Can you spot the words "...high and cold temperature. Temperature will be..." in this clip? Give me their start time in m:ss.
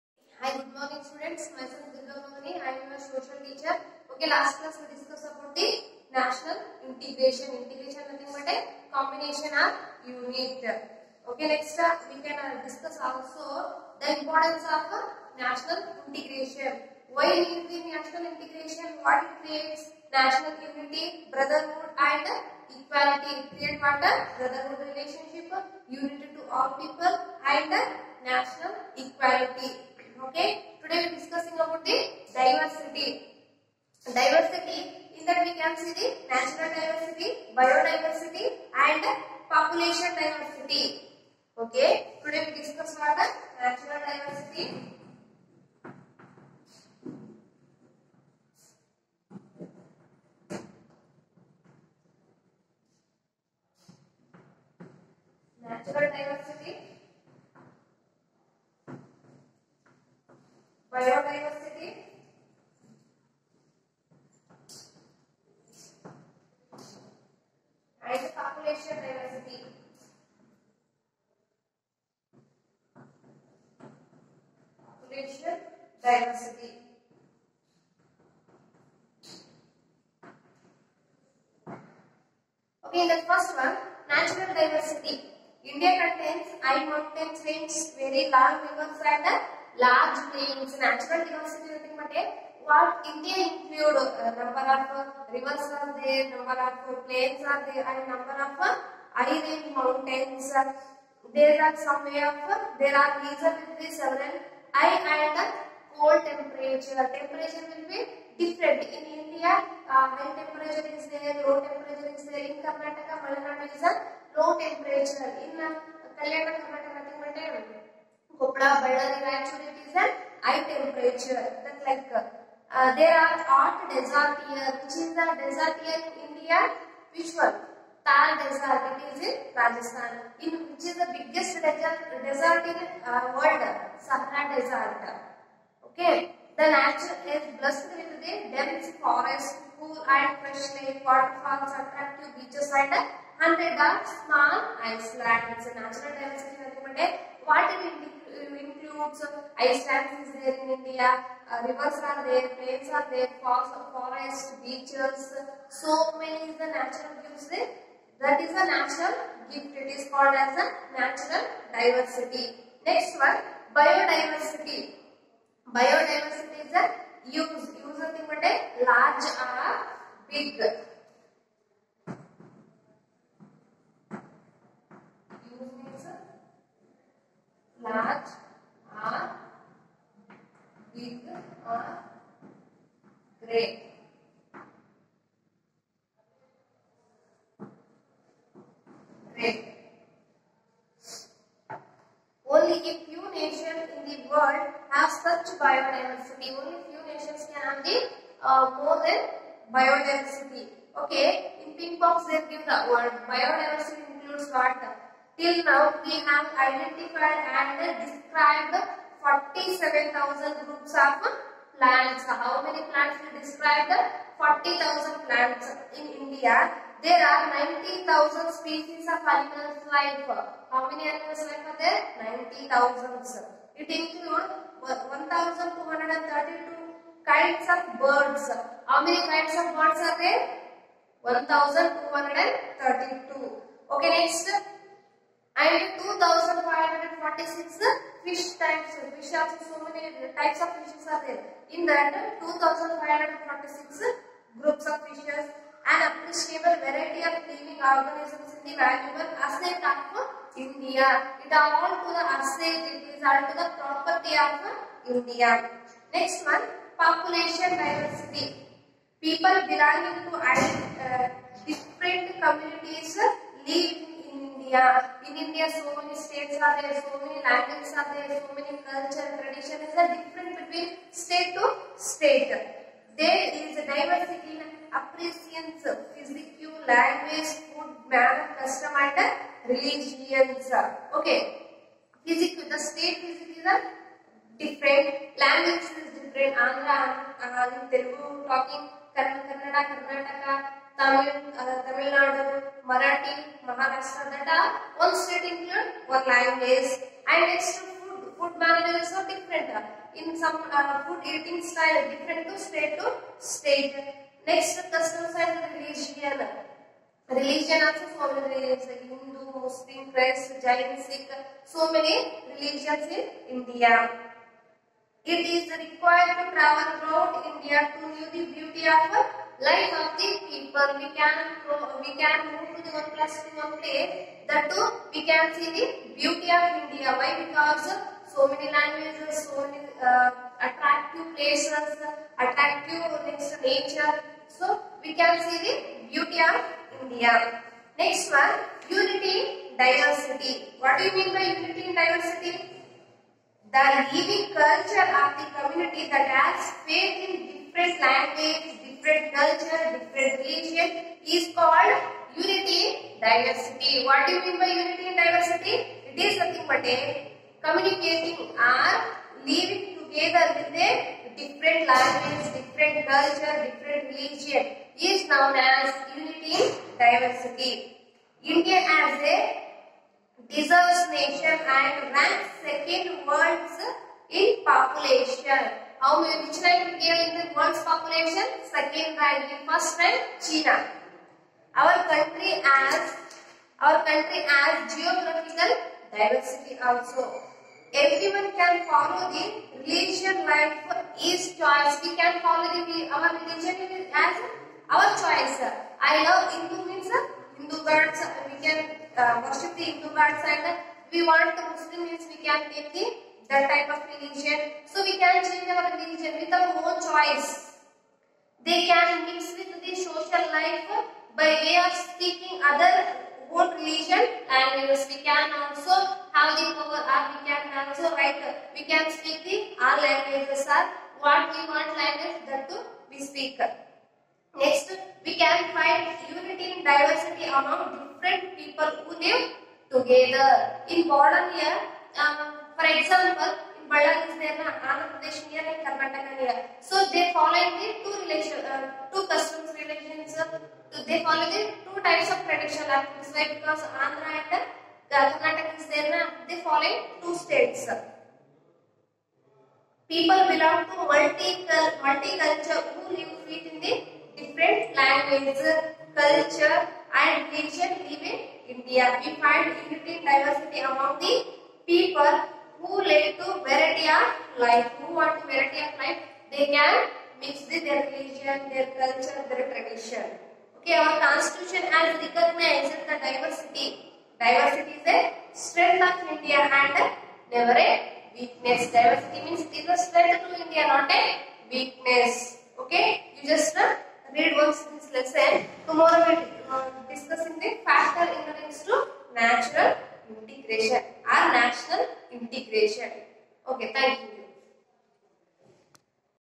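1:44.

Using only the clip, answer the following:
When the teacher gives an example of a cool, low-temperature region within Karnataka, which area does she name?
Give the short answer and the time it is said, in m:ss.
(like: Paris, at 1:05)
Malnadu, at 1:53.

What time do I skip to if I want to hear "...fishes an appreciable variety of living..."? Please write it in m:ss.
4:05.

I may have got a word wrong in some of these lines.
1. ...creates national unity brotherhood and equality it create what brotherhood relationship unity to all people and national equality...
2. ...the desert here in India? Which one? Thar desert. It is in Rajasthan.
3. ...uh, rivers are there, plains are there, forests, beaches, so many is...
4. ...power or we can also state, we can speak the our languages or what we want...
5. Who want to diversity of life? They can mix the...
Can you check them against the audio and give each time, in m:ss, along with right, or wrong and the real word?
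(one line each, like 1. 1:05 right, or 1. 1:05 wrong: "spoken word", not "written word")
1. 0:19 right
2. 2:05 right
3. 2:31 right
4. 6:56 wrong: "write", not "state"
5. 7:45 wrong: "variety", not "diversity".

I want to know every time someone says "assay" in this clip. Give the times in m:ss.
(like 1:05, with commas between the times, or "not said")
4:12.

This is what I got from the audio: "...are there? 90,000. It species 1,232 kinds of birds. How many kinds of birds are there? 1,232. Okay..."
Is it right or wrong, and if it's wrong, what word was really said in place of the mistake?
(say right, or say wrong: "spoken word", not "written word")
wrong: "includes", not "species".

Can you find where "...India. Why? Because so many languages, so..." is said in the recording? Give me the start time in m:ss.
5:26.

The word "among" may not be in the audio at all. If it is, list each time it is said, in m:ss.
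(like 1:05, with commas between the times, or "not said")
7:07, 7:40.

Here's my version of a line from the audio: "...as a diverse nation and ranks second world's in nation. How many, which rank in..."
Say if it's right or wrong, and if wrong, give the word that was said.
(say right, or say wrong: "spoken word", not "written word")
wrong: "population", not "nation".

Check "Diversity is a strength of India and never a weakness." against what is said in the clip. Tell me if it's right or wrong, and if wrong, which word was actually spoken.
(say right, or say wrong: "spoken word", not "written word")
right.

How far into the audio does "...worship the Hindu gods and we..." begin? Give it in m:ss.
6:39.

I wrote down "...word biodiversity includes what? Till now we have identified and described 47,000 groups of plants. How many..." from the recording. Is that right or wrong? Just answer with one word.
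right.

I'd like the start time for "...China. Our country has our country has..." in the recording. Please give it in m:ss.
6:20.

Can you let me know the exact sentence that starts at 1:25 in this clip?
India contains high mountain ranges, very long rivers and large plains.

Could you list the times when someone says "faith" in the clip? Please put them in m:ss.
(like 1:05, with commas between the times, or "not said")
5:46.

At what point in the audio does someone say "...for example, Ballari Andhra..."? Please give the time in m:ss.
7:12.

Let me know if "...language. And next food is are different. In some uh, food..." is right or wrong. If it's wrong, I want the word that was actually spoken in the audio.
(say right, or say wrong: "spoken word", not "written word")
right.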